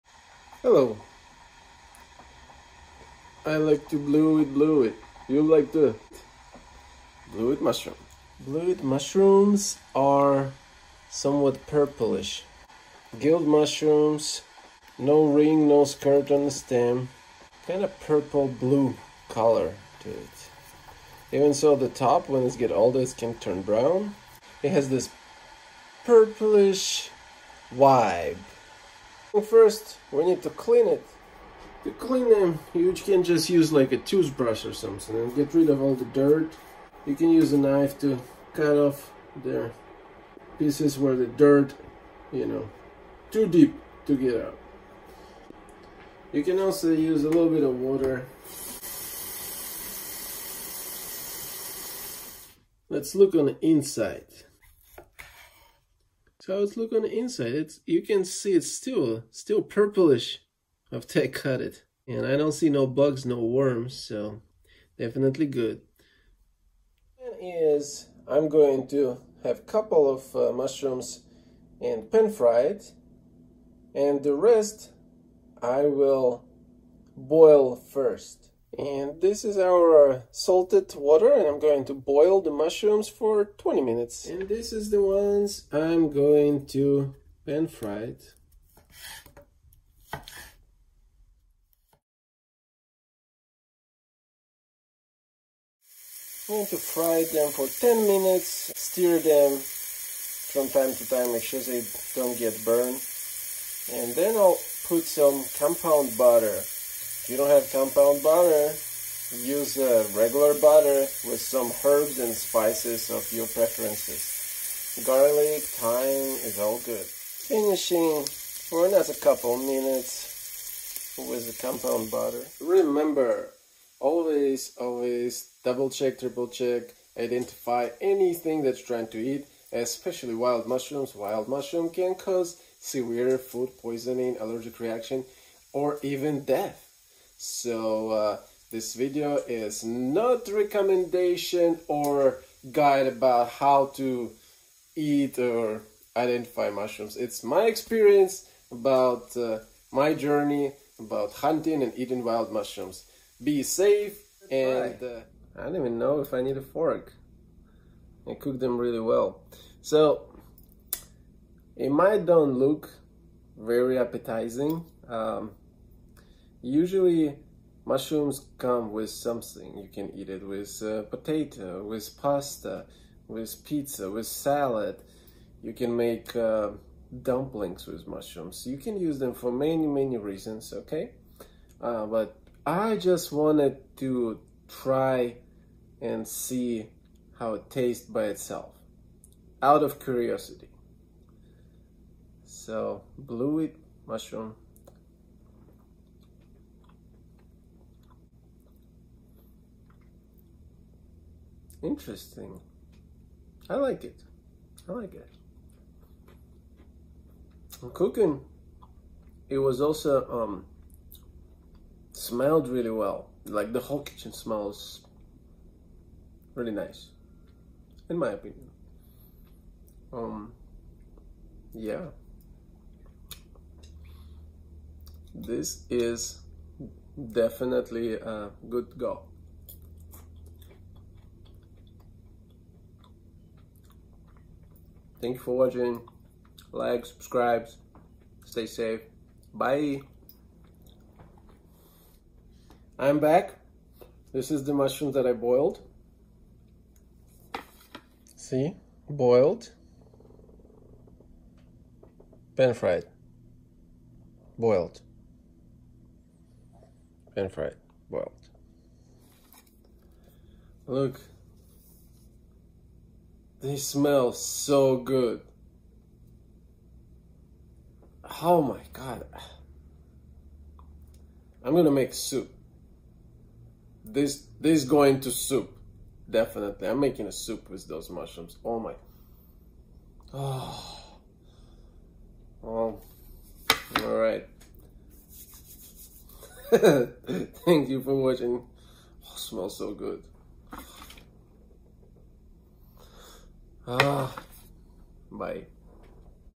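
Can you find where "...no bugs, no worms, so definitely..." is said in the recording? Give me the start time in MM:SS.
01:02.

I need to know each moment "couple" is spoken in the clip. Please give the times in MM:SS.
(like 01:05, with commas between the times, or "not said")
01:09, 01:59.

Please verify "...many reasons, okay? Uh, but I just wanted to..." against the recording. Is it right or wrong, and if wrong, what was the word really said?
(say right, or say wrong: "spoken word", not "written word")
right.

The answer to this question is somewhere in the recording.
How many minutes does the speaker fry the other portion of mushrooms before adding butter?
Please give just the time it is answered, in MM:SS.
01:37.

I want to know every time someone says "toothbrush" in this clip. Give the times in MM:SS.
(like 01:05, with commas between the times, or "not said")
00:33.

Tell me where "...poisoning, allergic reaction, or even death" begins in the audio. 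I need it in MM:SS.
02:13.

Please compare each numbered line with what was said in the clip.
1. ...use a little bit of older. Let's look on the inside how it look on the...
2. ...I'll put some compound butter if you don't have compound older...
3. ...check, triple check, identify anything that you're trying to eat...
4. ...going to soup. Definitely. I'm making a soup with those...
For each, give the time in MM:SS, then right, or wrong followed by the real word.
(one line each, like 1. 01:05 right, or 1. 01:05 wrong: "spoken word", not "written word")
1. 00:46 wrong: "water", not "older"
2. 01:44 wrong: "butter", not "older"
3. 02:05 right
4. 04:34 right.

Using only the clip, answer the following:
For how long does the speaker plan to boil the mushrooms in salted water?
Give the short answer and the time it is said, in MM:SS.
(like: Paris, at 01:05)
20 minutes, at 01:23.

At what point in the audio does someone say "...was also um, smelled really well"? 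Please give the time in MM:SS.
03:29.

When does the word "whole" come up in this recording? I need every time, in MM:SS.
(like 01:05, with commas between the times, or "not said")
03:33.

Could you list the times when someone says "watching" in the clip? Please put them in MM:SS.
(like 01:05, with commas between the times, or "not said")
03:55, 04:48.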